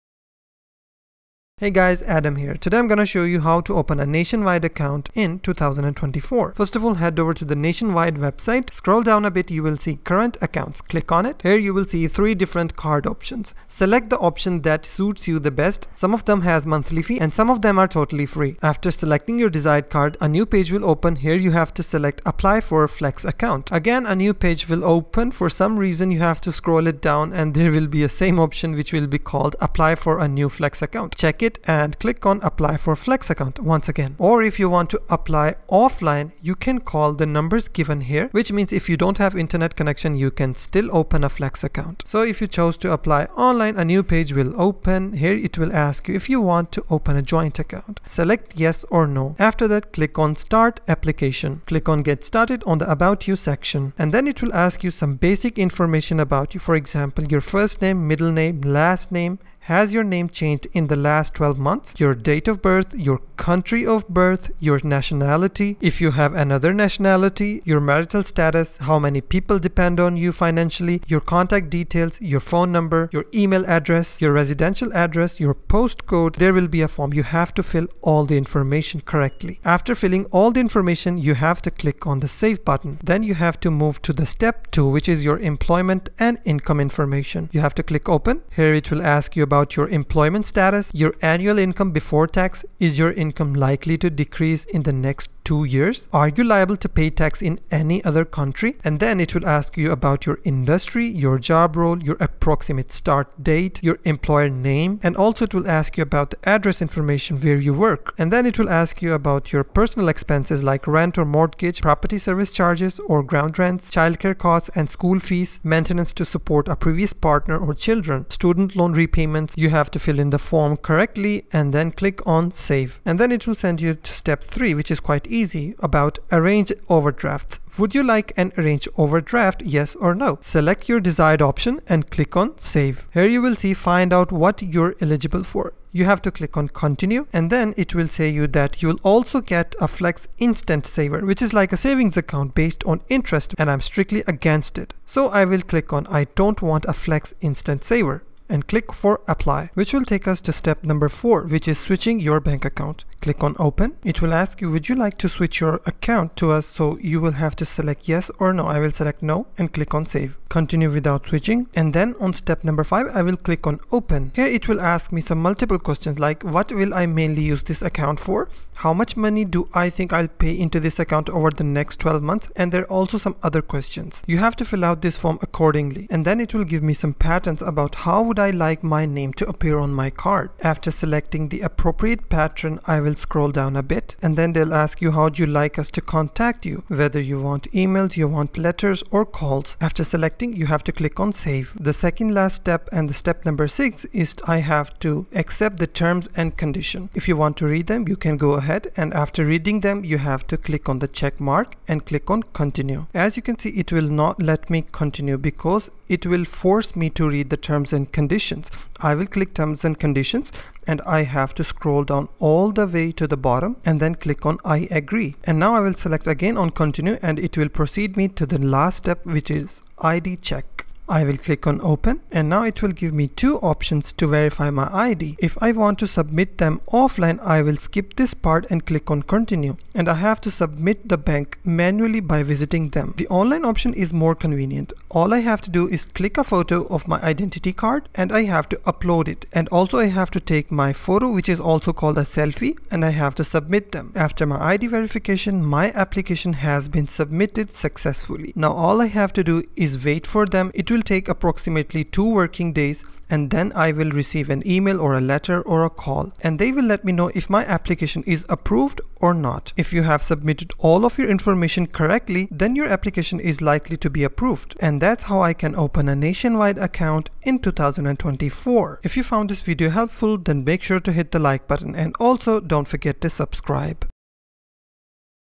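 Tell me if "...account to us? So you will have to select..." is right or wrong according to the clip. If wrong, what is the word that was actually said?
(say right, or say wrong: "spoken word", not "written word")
right.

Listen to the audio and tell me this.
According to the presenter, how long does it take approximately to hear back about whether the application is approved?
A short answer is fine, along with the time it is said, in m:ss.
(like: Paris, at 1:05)
2 working days, at 4:12.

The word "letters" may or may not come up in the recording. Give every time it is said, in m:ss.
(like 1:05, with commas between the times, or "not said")
3:08, 4:15.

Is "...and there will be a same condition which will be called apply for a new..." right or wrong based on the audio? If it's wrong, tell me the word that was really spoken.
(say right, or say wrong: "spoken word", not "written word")
wrong: "option", not "condition".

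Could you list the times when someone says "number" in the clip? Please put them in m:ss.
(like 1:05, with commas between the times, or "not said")
0:37, 1:12, 2:30, 2:42, 3:13.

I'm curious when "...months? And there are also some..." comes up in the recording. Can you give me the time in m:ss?
2:52.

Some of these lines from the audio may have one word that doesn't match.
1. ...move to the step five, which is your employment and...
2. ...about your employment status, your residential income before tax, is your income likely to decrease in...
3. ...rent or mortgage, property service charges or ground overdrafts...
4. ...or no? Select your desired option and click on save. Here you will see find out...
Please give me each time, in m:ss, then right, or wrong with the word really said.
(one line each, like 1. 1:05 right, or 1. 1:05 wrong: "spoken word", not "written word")
1. 1:23 wrong: "two", not "five"
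2. 1:29 wrong: "annual", not "residential"
3. 1:50 wrong: "rents", not "overdrafts"
4. 2:09 right.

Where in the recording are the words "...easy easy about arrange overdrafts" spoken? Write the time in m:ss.
2:05.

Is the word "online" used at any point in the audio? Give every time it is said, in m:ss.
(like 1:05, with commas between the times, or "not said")
0:43, 3:53.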